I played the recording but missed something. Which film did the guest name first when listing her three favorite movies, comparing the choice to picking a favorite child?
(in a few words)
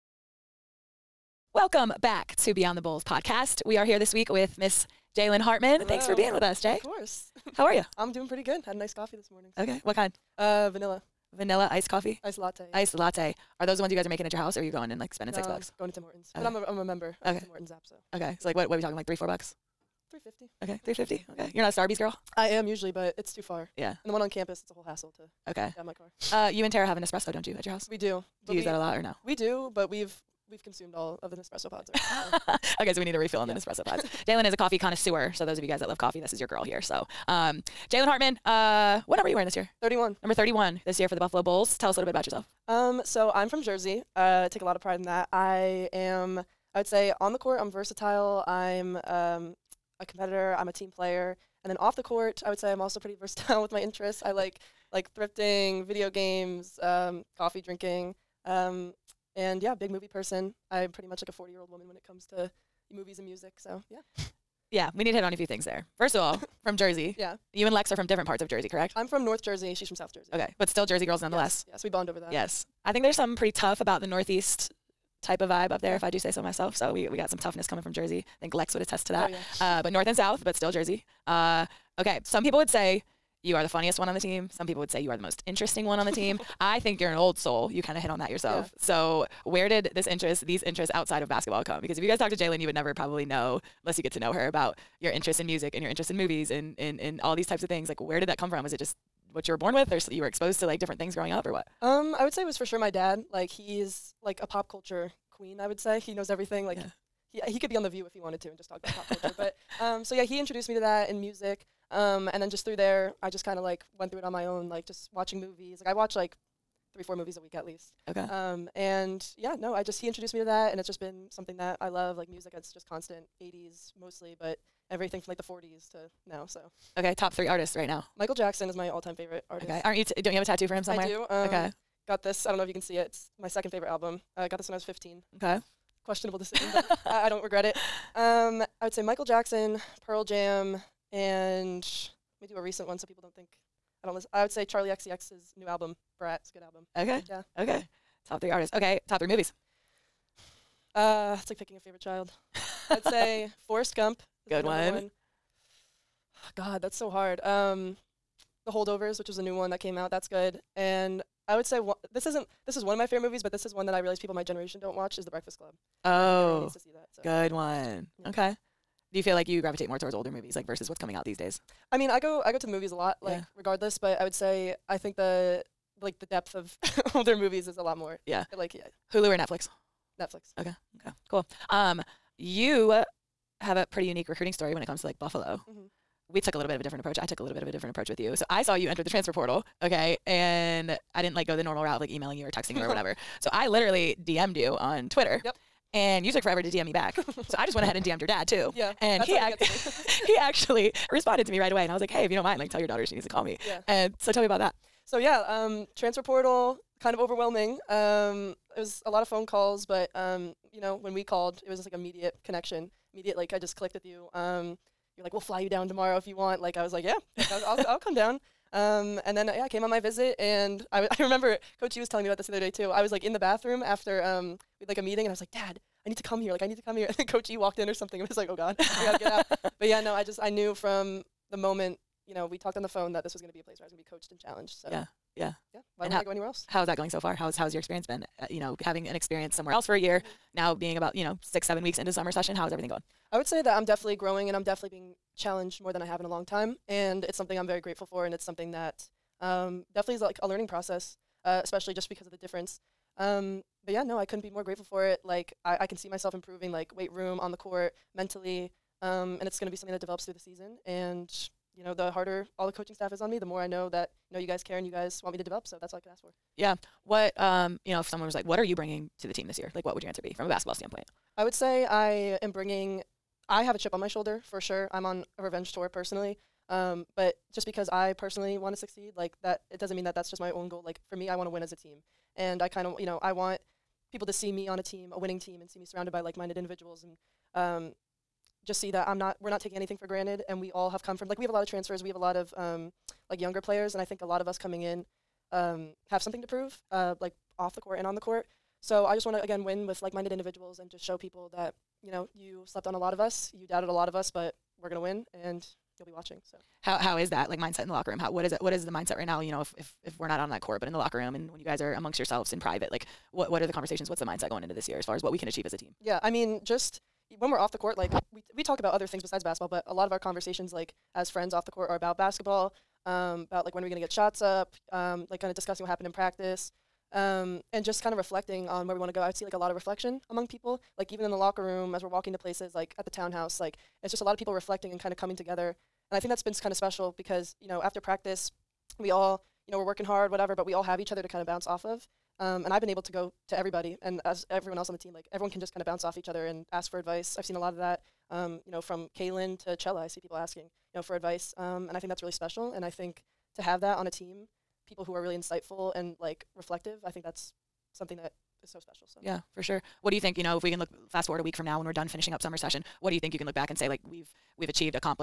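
Forrest Gump.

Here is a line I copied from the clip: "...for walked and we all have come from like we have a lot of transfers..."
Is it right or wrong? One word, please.
wrong.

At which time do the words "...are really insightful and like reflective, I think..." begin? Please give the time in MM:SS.
05:55.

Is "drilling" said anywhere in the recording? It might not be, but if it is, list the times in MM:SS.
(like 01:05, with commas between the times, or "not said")
not said.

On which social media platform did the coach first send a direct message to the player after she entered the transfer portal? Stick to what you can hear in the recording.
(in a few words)
Twitter.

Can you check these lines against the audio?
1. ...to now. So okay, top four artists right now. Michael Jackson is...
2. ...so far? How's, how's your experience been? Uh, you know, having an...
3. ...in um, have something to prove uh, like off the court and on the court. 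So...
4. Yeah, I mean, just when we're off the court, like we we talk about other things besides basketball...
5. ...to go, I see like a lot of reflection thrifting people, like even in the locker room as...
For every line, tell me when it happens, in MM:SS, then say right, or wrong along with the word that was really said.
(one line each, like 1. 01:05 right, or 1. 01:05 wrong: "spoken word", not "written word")
1. 02:05 wrong: "three", not "four"
2. 03:57 right
3. 04:54 right
4. 05:16 right
5. 05:29 wrong: "among", not "thrifting".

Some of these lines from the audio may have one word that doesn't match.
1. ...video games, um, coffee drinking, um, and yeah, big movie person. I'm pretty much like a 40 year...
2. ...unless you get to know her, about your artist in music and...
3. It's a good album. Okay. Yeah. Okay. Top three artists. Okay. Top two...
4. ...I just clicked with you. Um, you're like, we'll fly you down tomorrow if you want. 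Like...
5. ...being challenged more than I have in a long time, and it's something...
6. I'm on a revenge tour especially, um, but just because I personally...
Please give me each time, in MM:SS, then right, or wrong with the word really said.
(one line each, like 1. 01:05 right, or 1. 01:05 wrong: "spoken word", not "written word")
1. 00:55 right
2. 01:33 wrong: "interest", not "artist"
3. 02:26 wrong: "three", not "two"
4. 03:33 right
5. 04:04 right
6. 04:34 wrong: "personally", not "especially".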